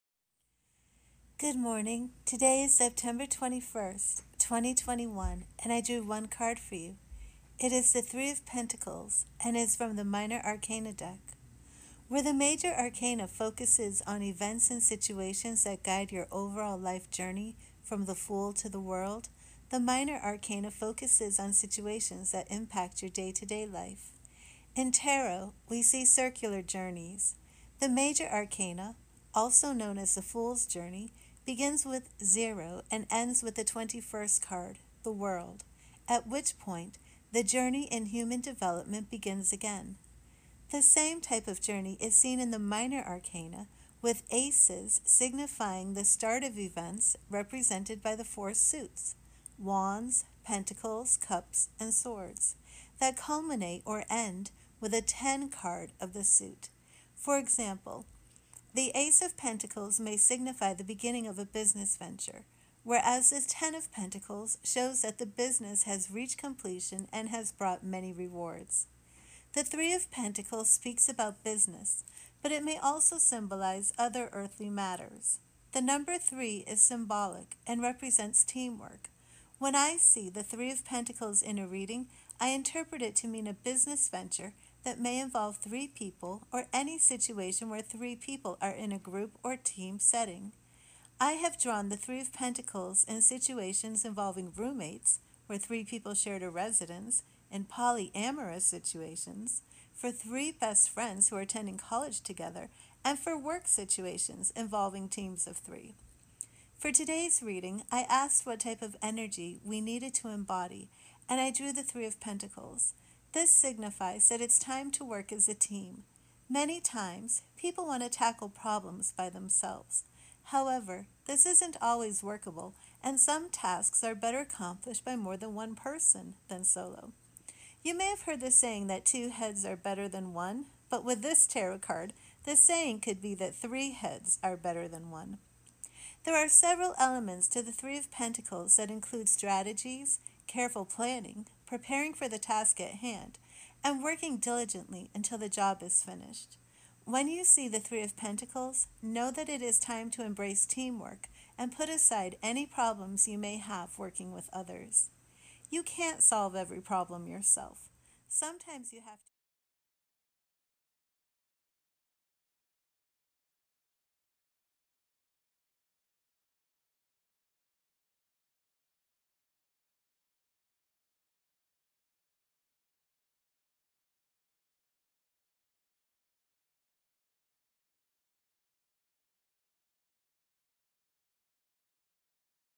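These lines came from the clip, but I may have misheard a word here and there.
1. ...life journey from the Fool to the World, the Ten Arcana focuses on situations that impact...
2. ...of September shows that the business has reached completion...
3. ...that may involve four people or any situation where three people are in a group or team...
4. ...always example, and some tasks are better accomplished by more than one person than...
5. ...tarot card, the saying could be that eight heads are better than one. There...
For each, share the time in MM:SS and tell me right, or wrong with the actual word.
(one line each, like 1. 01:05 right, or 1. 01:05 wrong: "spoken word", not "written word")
1. 00:16 wrong: "Minor", not "Ten"
2. 01:03 wrong: "Pentacles", not "September"
3. 01:24 wrong: "three", not "four"
4. 02:01 wrong: "workable", not "example"
5. 02:11 wrong: "three", not "eight".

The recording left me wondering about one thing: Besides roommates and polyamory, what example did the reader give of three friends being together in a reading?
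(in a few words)
attending college together.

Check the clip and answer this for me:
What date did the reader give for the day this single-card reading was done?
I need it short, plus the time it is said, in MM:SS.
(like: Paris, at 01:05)
September 21st, 2021, at 00:02.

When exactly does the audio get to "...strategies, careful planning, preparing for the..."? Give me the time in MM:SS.
02:19.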